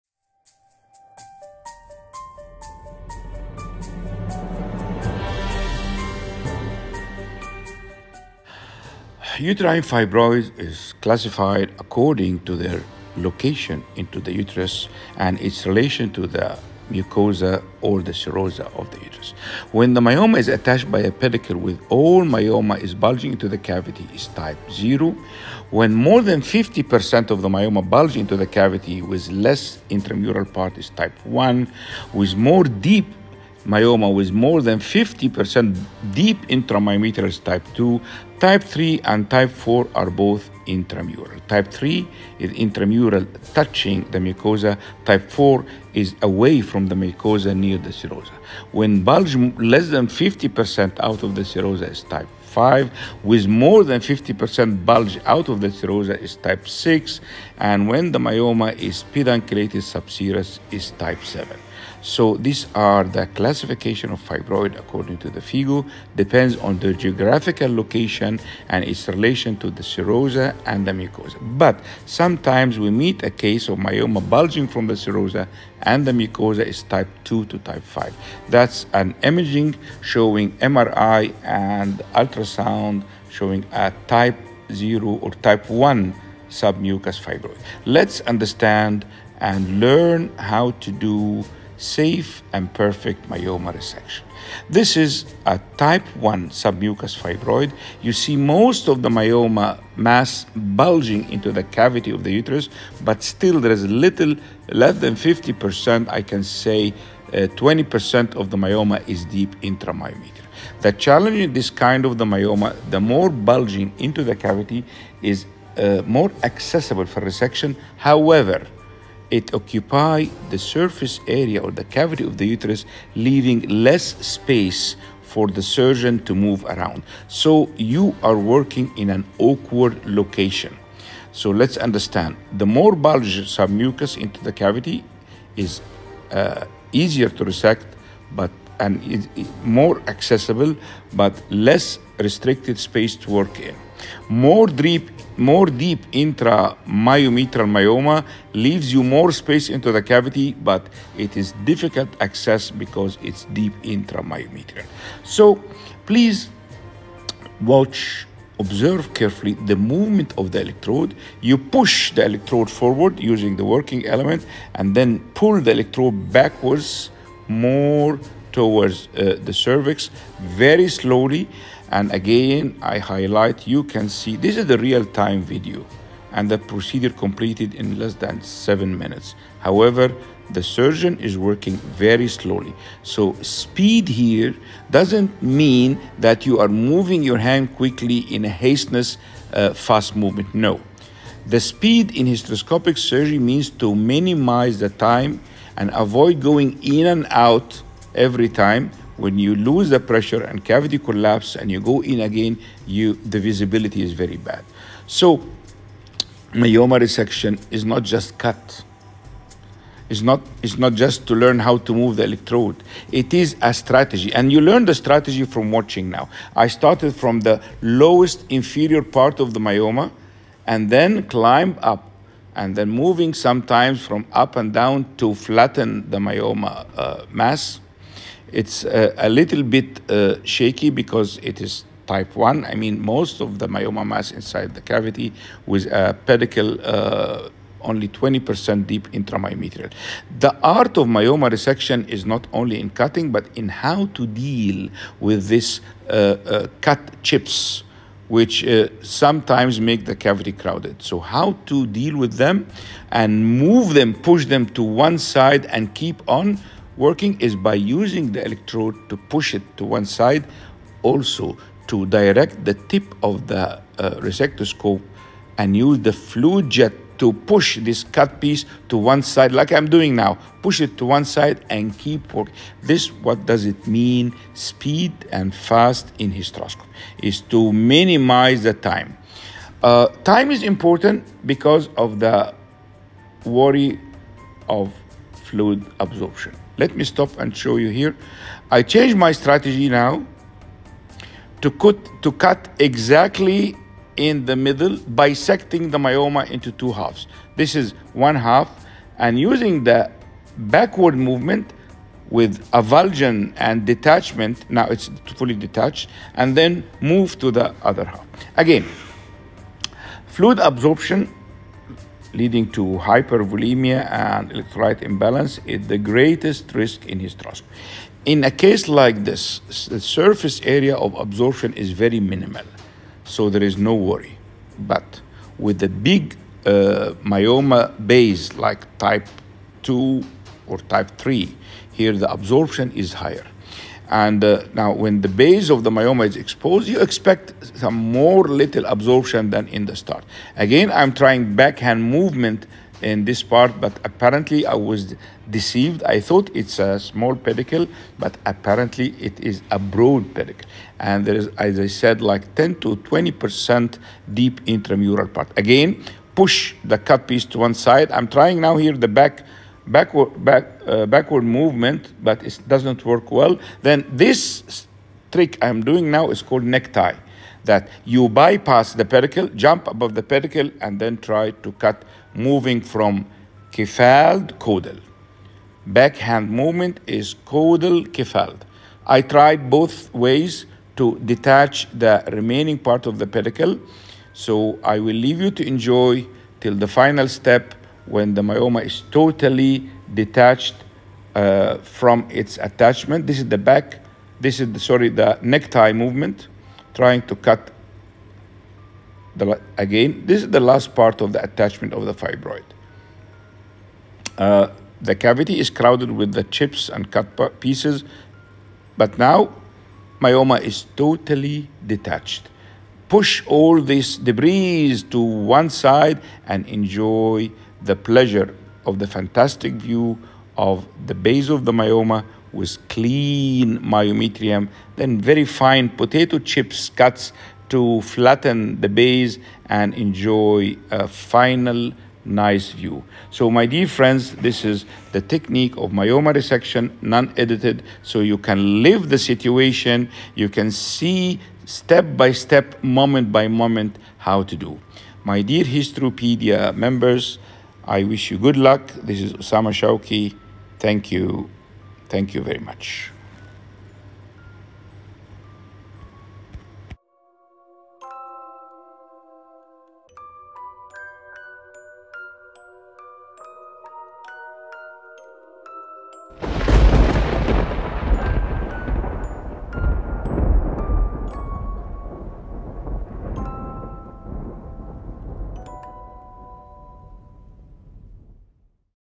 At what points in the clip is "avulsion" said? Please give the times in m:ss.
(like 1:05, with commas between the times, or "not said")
5:02.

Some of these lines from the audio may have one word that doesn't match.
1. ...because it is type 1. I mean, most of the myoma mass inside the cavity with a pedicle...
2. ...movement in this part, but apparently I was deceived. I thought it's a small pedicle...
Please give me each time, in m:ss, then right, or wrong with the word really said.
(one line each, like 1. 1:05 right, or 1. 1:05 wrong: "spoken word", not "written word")
1. 3:50 right
2. 5:42 right.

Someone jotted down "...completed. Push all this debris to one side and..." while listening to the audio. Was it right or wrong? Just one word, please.
wrong.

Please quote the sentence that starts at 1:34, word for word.
This is a type 1 submucous fibroid.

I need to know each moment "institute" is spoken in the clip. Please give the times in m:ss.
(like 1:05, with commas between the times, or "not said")
not said.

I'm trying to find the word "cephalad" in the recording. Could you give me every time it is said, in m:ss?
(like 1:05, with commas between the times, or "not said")
6:13, 6:18.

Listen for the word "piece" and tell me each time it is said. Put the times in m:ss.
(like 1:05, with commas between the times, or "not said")
4:28, 5:57, 6:47.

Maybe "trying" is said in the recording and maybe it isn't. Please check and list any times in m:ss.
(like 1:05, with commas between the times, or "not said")
5:41, 5:58, 6:36.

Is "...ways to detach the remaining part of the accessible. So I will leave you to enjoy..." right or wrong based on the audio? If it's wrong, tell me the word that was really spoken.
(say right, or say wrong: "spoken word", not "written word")
wrong: "pedicle", not "accessible".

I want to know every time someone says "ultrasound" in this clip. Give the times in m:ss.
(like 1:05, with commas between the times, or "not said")
1:22.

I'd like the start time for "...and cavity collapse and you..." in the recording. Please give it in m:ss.
3:20.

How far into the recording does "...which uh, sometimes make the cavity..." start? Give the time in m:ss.
4:08.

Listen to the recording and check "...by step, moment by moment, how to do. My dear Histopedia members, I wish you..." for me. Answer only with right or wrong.
right.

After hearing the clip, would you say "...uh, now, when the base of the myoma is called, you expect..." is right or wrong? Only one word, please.
wrong.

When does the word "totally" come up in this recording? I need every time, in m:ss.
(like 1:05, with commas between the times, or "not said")
6:29, 6:50.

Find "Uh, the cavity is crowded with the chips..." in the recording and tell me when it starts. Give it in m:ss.
6:44.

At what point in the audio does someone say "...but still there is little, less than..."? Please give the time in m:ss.
1:43.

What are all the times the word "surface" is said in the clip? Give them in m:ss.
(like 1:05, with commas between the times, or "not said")
2:00, 5:19.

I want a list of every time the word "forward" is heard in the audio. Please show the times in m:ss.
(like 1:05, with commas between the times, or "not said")
2:42.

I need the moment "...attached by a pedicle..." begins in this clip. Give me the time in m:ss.
0:20.